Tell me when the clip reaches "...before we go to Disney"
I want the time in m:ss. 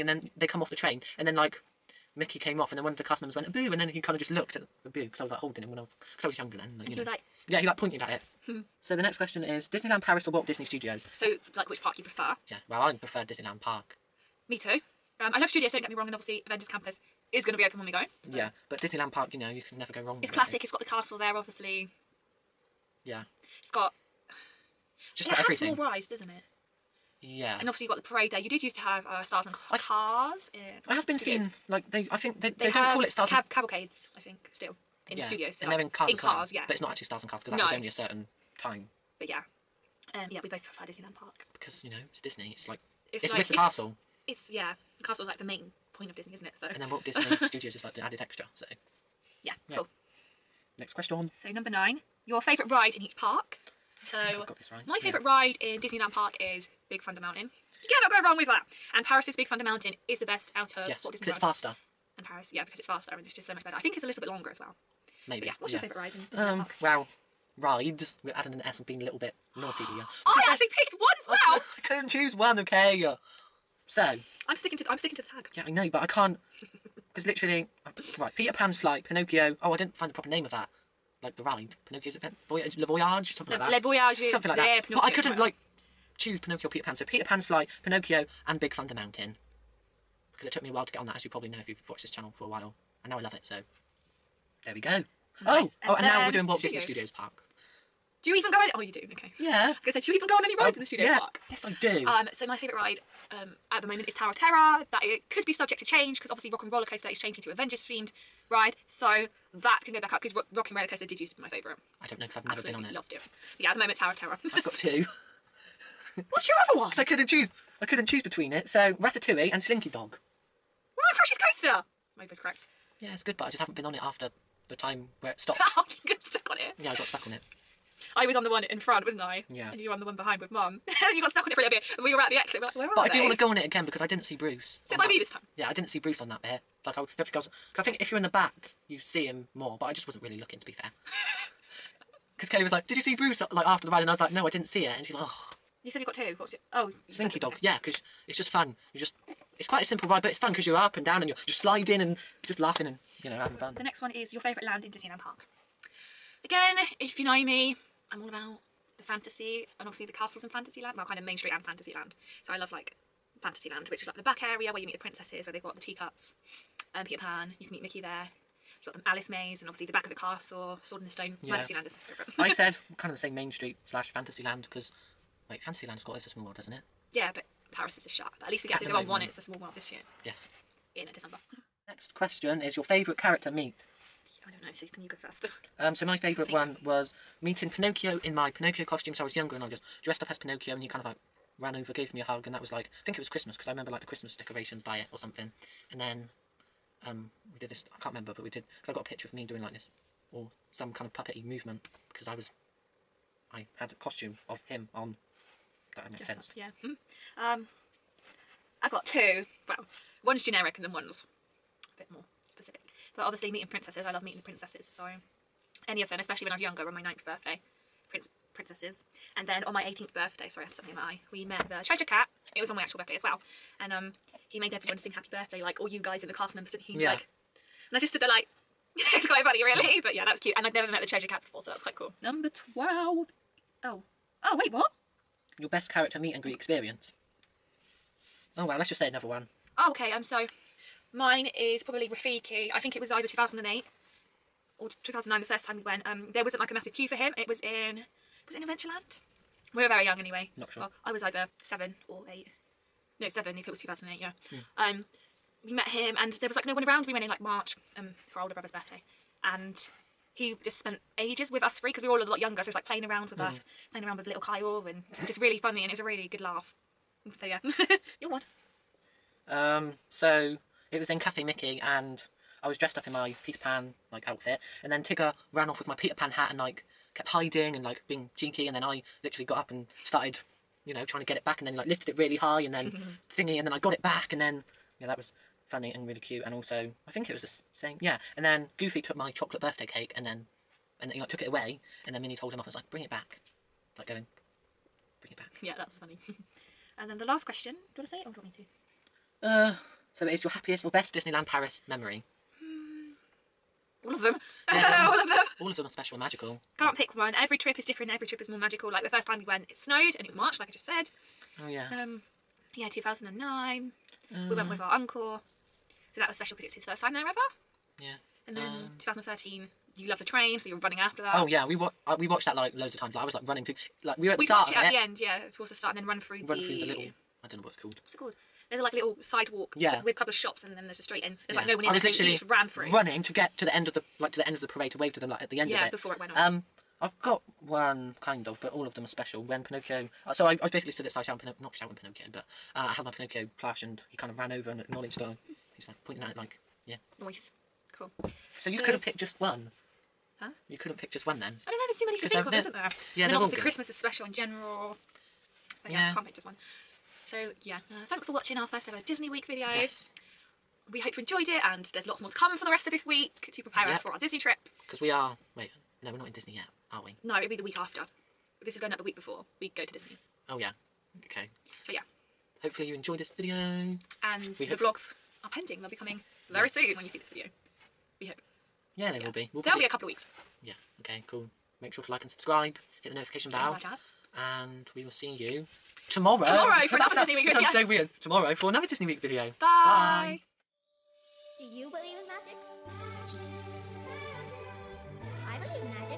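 6:09.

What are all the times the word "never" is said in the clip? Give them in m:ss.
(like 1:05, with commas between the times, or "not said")
0:19, 1:52, 3:50.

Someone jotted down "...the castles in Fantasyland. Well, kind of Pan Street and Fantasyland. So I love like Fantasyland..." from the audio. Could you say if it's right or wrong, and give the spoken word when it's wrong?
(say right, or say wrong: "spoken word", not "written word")
wrong: "Main", not "Pan".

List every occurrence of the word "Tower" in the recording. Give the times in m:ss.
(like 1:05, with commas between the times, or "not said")
1:44, 1:53.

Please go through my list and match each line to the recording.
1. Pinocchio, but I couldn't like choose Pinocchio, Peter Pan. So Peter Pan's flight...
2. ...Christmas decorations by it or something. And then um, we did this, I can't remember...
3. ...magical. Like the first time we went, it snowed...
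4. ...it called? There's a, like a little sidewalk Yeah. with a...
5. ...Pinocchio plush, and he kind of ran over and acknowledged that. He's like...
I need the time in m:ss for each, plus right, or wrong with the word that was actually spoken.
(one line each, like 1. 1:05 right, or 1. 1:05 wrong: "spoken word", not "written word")
1. 1:24 right
2. 3:14 right
3. 5:08 right
4. 5:28 right
5. 5:43 right.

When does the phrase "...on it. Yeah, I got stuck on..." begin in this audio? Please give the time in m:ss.
2:06.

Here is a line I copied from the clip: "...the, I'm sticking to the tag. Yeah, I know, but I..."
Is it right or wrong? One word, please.
right.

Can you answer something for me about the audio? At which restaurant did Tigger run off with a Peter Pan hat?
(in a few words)
Cafe Mickey.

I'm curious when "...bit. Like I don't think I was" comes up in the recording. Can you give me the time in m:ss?
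2:16.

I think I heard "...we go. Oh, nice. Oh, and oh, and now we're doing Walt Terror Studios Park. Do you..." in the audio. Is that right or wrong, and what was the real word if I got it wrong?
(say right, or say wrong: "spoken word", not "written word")
wrong: "Disney", not "Terror".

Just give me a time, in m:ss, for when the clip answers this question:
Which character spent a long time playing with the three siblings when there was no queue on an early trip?
4:02.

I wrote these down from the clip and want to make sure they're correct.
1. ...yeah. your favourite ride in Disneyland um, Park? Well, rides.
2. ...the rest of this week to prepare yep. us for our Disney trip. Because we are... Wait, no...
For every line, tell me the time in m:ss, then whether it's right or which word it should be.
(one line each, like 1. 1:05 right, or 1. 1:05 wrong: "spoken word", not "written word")
1. 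1:05 right
2. 6:02 right.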